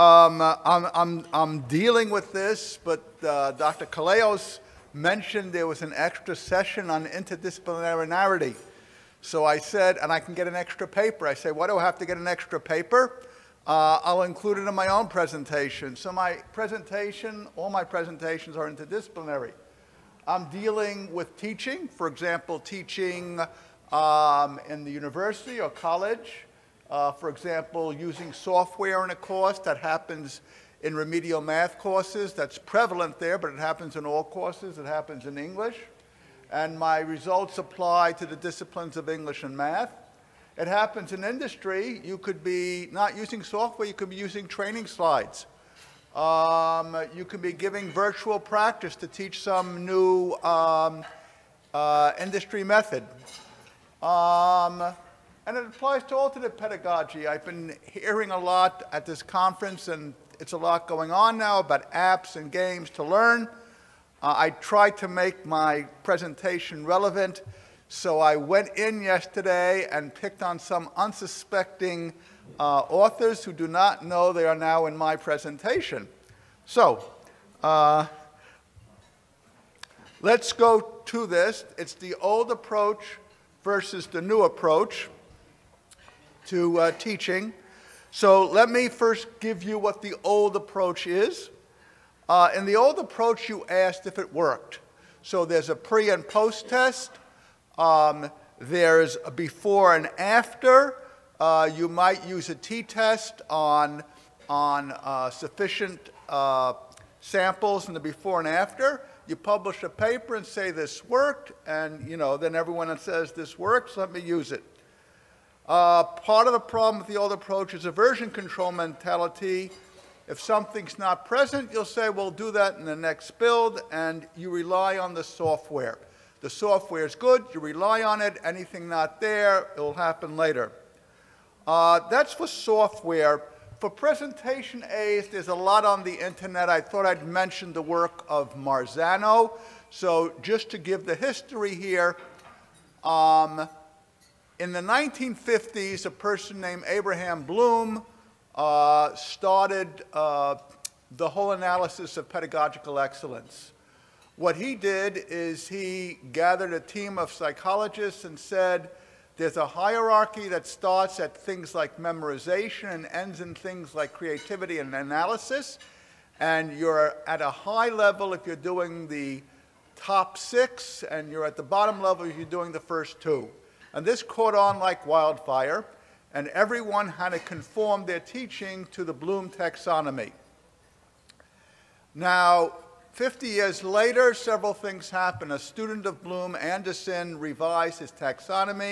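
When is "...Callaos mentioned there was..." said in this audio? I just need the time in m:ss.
0:03.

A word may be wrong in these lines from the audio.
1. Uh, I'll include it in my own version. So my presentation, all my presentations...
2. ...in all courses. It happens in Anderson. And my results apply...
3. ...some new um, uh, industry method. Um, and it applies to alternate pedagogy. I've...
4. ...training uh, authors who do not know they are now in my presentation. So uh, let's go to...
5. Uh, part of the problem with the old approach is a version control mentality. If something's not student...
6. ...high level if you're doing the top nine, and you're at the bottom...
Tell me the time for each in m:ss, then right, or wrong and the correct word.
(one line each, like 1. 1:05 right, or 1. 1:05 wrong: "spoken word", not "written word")
1. 0:13 wrong: "presentation", not "version"
2. 0:33 wrong: "English", not "Anderson"
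3. 0:49 right
4. 1:10 wrong: "unsuspecting", not "training"
5. 1:55 wrong: "present", not "student"
6. 2:47 wrong: "six", not "nine".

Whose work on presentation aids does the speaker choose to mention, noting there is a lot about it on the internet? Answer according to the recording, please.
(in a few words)
Marzano.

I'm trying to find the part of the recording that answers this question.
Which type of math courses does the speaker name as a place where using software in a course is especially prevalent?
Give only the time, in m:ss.
0:30.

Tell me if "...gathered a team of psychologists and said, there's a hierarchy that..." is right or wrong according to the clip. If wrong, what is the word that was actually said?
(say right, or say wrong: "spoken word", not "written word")
right.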